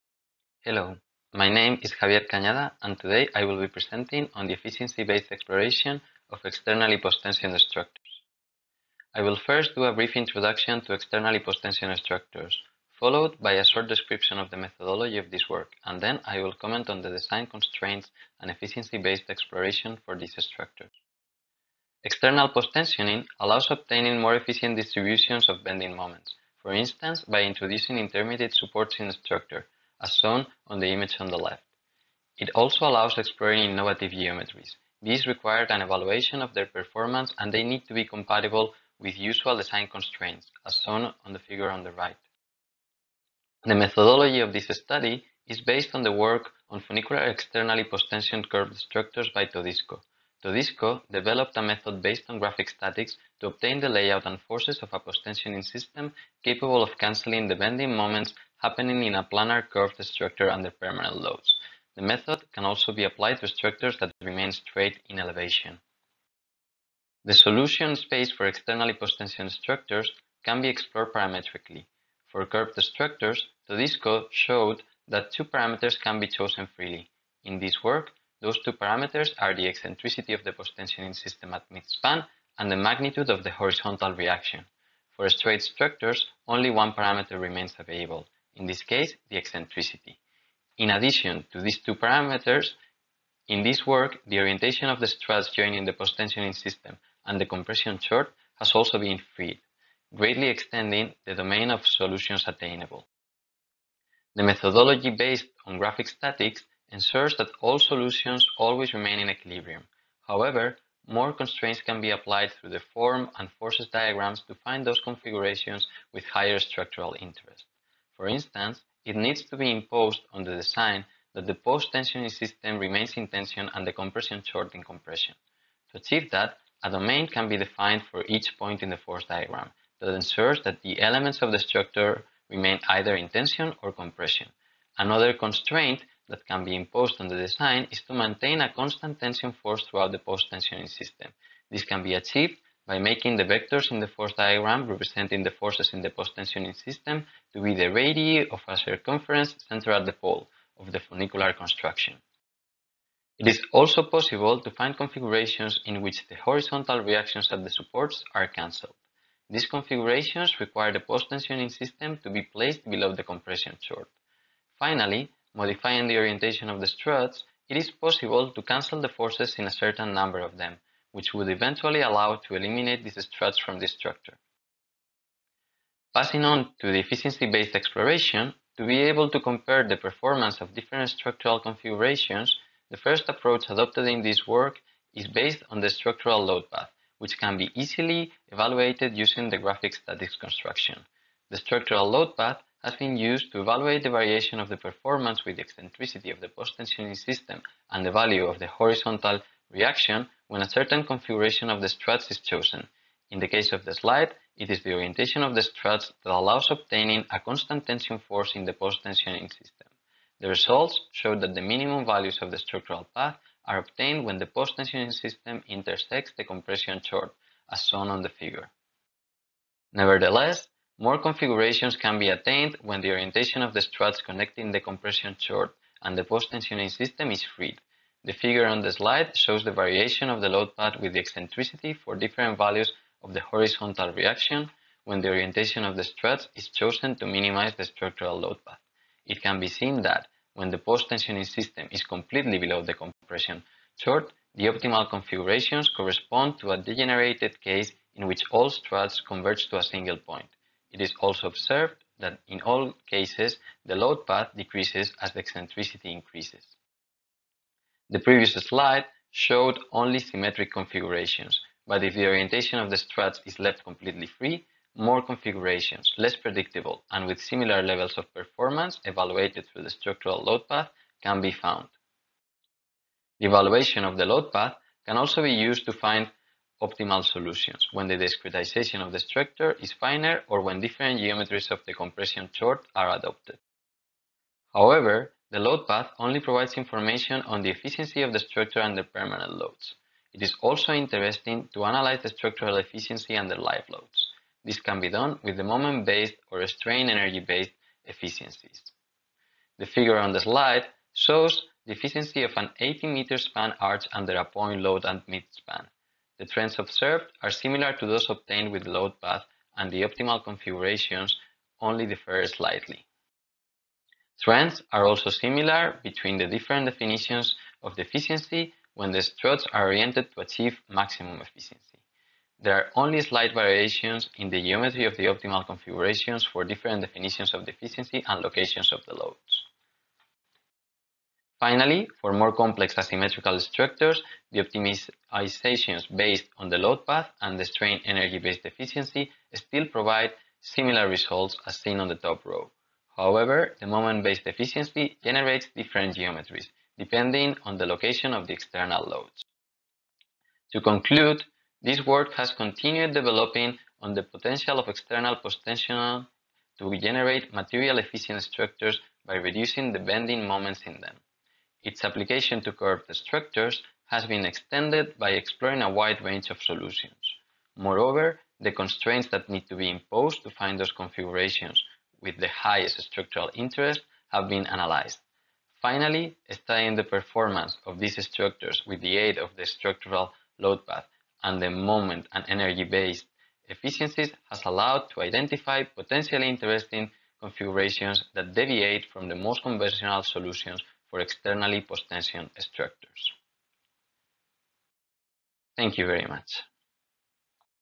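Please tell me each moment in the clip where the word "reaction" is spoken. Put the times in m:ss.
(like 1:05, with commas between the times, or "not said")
1:24, 2:37, 3:19, 3:54.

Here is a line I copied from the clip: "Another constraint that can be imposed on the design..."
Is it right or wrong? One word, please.
right.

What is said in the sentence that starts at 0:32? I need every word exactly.
It also allows exploring innovative geometries.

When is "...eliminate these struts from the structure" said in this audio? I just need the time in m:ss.
2:52.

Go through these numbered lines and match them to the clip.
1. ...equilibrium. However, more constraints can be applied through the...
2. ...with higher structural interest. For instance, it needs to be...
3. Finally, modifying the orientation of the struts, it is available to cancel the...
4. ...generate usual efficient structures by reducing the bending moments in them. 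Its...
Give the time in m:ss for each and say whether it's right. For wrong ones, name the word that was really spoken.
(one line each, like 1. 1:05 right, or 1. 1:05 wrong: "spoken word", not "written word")
1. 1:49 right
2. 1:56 right
3. 2:44 wrong: "possible", not "available"
4. 5:56 wrong: "material", not "usual".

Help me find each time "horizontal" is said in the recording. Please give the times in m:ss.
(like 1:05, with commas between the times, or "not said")
1:23, 2:36, 3:18, 3:53.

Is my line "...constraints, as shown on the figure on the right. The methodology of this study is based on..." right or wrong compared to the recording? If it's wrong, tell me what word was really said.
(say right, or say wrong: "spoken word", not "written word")
right.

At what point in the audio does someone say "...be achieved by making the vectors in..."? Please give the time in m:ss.
2:22.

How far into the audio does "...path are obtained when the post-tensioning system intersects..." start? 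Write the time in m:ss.
3:33.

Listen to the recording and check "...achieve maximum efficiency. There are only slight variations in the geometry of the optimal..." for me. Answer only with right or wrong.
right.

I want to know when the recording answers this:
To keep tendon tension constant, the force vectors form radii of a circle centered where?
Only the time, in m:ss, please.
2:30.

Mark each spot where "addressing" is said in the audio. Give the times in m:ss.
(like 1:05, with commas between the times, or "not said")
not said.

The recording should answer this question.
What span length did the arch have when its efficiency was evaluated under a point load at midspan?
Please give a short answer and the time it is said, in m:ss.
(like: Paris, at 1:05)
80 meters, at 5:02.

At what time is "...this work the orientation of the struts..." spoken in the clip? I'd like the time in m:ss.
1:33.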